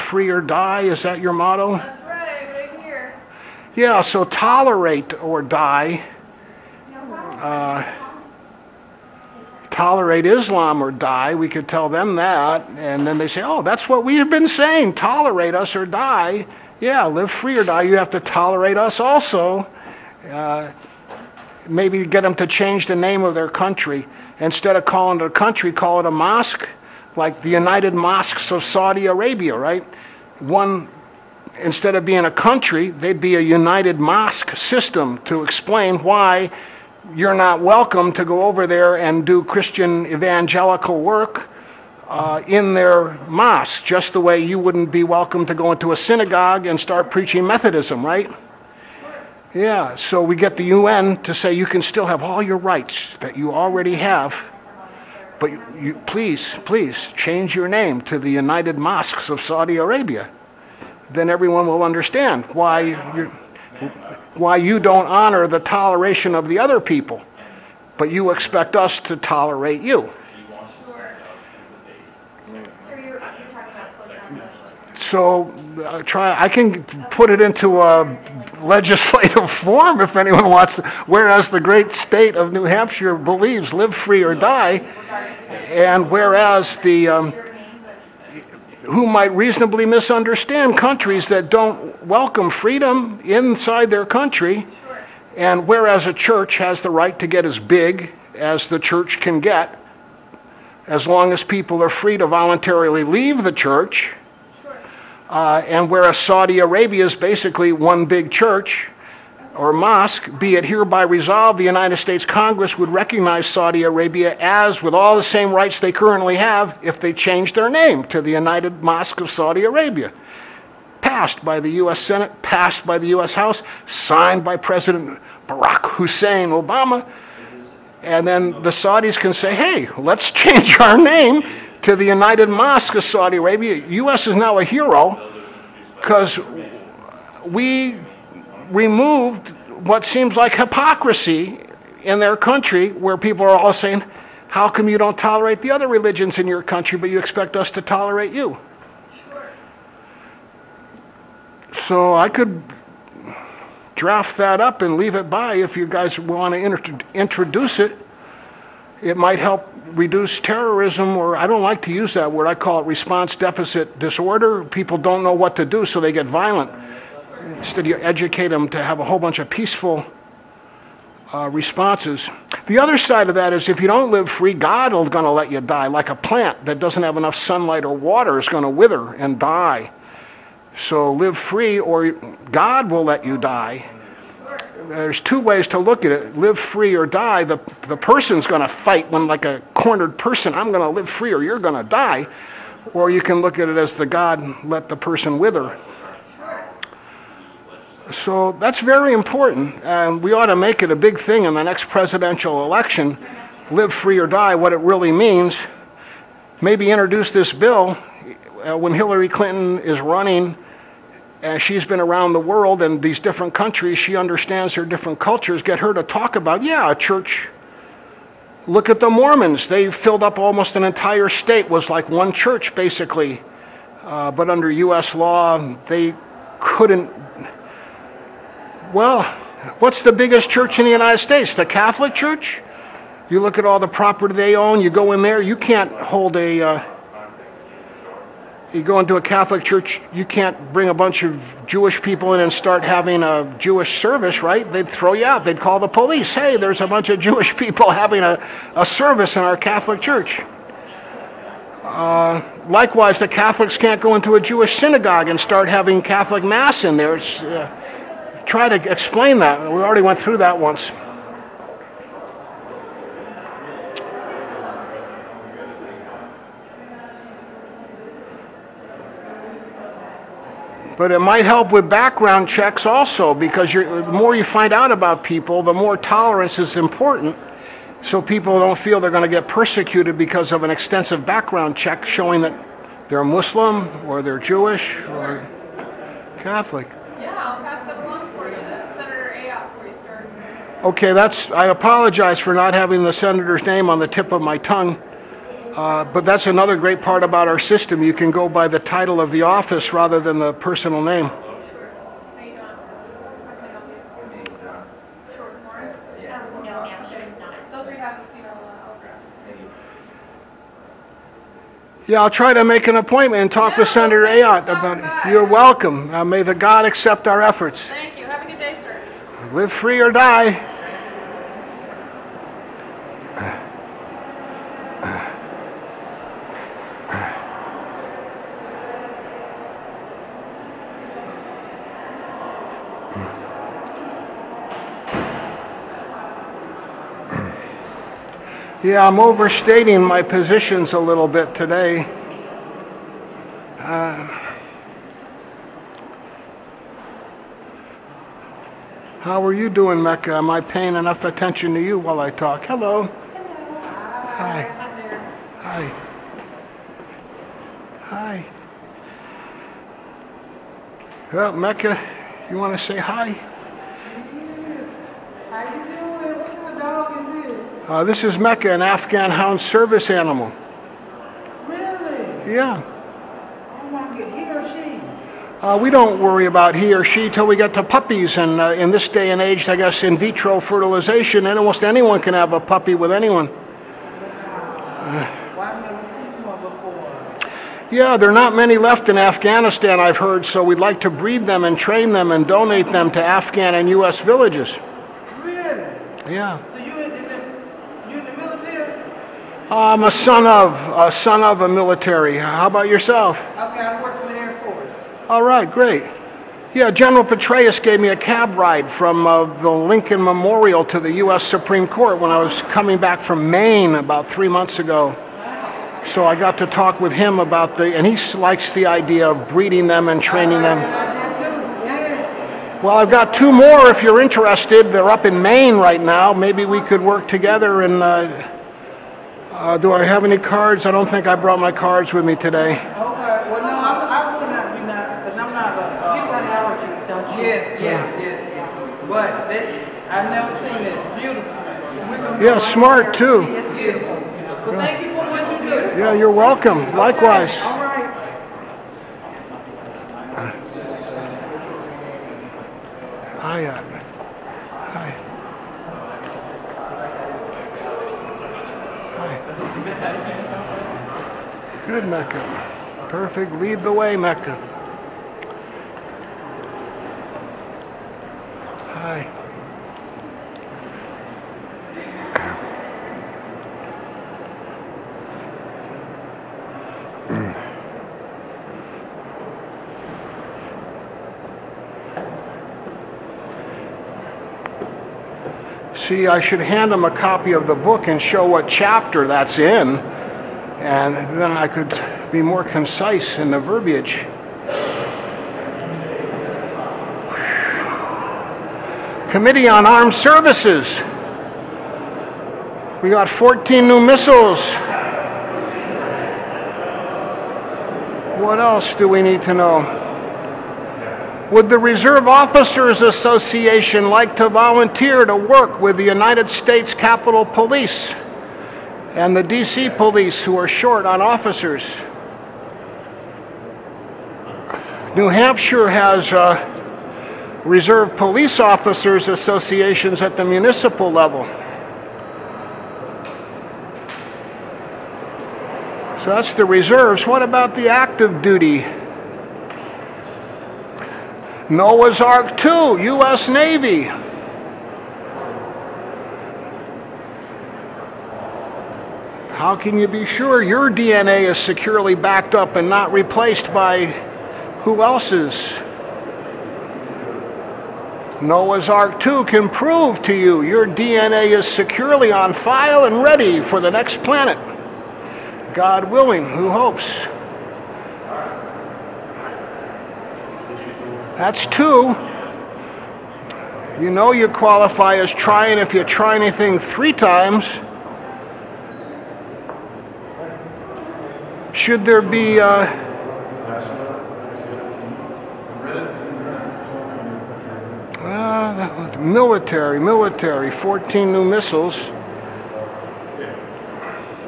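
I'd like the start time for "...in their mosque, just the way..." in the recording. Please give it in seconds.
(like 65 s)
42 s.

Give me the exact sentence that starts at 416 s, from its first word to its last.
So I got to talk with him about the, and he likes the idea of breeding them and training them.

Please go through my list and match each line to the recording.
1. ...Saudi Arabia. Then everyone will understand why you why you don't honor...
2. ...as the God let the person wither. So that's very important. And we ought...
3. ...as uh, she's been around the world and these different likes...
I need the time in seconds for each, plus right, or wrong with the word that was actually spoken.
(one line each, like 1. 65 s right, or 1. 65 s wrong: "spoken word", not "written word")
1. 59 s right
2. 193 s right
3. 211 s wrong: "countries", not "likes".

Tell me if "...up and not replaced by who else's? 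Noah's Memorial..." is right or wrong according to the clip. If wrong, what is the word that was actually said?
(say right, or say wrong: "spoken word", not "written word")
wrong: "Ark", not "Memorial".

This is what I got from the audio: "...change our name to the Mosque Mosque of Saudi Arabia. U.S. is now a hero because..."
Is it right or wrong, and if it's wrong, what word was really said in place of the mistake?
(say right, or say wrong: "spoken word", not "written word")
wrong: "United", not "Mosque".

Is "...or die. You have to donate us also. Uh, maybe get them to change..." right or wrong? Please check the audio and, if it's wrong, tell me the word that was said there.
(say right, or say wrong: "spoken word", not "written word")
wrong: "tolerate", not "donate".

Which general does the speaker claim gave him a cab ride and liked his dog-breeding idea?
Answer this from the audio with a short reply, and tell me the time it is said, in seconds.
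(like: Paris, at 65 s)
General Petraeus, at 406 s.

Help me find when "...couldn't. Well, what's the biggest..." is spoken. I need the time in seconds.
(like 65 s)
226 s.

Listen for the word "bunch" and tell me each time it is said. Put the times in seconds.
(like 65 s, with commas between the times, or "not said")
169 s, 240 s, 246 s.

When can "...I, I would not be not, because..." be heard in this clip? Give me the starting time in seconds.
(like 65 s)
433 s.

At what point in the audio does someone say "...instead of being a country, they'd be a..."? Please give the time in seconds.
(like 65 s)
31 s.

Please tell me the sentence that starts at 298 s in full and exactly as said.
You can go by the title of the office rather than the personal name.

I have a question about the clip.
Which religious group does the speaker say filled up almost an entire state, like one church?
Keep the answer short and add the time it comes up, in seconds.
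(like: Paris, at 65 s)
The Mormons, at 218 s.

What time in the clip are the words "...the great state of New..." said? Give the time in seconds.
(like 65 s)
81 s.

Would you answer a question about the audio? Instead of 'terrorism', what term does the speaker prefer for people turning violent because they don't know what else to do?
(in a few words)
Response deficit disorder.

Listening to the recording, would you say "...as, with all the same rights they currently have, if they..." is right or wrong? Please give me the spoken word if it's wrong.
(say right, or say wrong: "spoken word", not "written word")
right.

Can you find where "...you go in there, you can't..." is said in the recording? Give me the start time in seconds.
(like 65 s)
234 s.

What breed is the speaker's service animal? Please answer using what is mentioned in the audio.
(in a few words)
Afghan hound.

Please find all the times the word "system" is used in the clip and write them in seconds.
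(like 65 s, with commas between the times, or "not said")
34 s, 297 s.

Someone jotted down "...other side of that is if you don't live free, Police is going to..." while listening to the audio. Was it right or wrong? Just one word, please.
wrong.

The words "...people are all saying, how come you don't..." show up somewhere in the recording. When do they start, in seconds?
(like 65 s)
143 s.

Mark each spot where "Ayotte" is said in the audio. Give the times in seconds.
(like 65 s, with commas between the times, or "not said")
289 s, 314 s.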